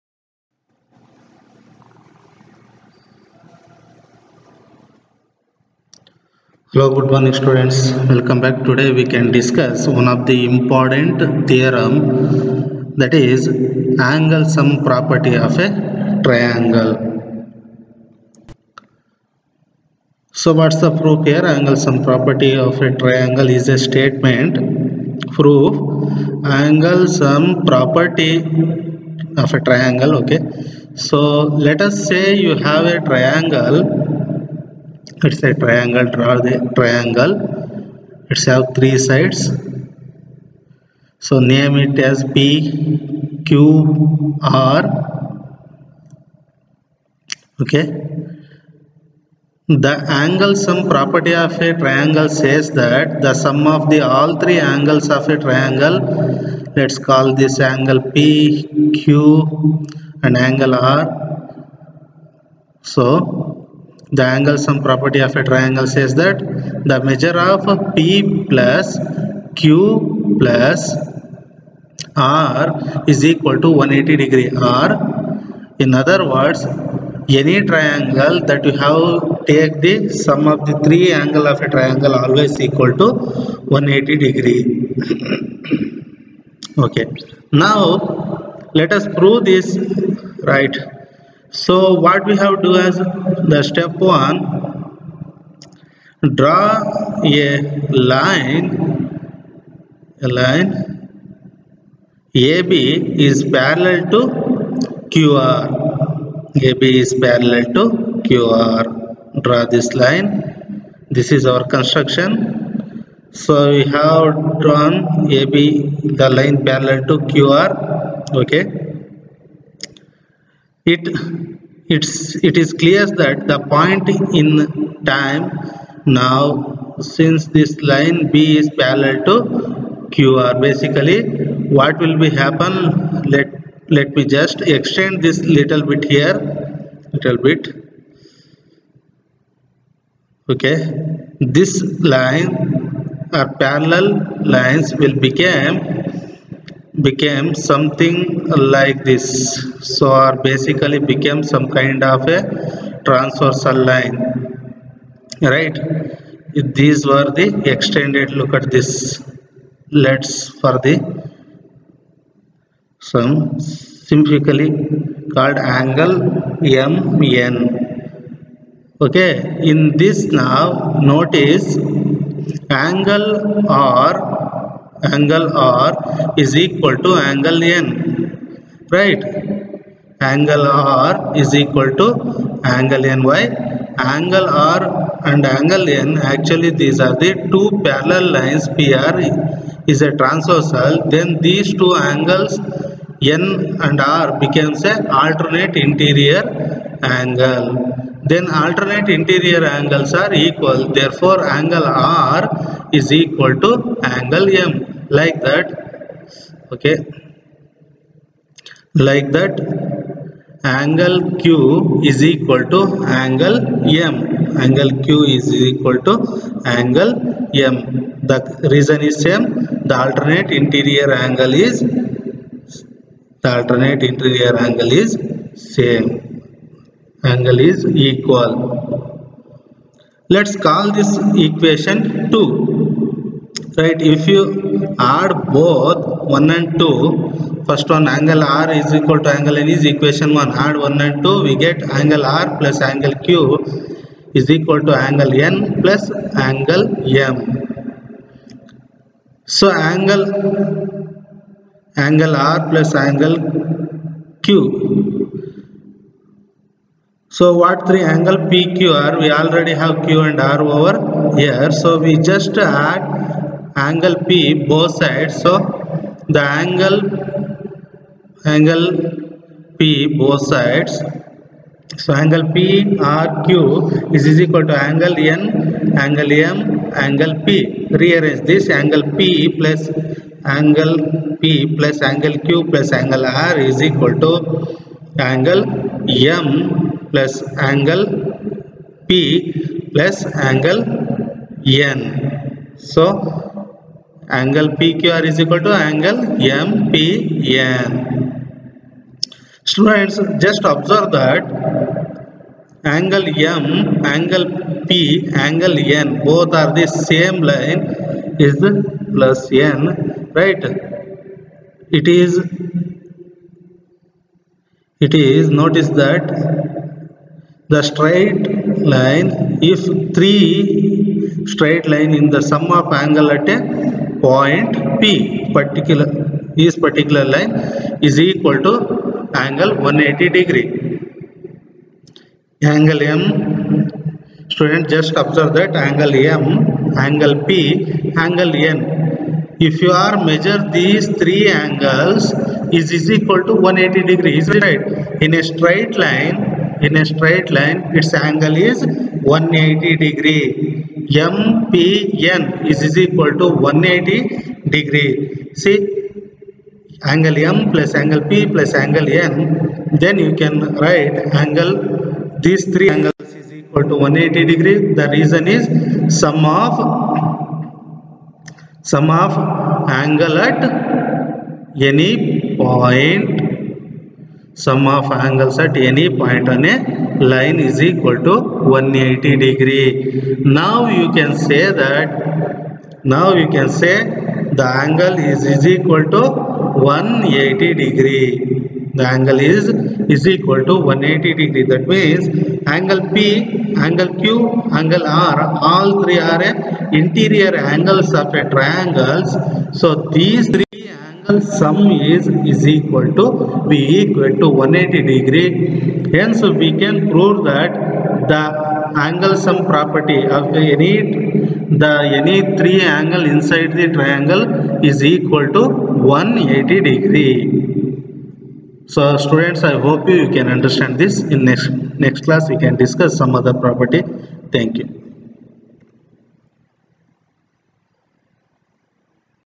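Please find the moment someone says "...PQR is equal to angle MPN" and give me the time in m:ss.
4:54.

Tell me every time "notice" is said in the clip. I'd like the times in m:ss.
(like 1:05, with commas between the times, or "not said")
2:51, 5:15.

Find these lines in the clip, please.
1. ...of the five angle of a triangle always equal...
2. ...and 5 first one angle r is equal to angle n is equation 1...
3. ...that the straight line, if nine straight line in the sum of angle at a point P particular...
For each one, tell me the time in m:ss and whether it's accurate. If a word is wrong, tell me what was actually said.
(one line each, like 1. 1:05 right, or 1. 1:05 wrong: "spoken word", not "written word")
1. 1:20 wrong: "three", not "five"
2. 3:56 wrong: "2", not "5"
3. 5:15 wrong: "three", not "nine".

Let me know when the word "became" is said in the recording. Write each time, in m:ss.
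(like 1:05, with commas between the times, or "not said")
2:26, 2:30.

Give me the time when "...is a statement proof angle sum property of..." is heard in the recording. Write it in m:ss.
0:23.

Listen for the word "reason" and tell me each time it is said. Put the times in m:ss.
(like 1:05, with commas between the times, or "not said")
3:38, 6:05.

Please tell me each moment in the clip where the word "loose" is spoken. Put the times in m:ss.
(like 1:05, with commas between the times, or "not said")
not said.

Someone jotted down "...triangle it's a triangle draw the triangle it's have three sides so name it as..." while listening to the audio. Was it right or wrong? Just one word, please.
right.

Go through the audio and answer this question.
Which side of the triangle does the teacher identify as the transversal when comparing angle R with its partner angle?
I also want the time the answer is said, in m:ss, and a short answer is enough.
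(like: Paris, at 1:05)
PR, at 3:08.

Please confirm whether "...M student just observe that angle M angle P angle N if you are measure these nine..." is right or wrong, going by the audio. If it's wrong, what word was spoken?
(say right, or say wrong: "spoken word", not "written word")
wrong: "three", not "nine".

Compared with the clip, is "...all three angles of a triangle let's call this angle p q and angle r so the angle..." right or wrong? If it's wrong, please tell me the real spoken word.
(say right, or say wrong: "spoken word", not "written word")
right.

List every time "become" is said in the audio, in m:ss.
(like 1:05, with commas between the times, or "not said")
2:25, 3:14.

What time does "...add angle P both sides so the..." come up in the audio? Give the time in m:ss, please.
4:22.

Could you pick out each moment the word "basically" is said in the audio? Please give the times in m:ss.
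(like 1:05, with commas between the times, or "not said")
2:10, 2:30.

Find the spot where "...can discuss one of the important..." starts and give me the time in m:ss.
0:09.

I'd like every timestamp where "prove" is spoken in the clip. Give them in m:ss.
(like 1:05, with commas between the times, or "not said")
1:29, 6:47.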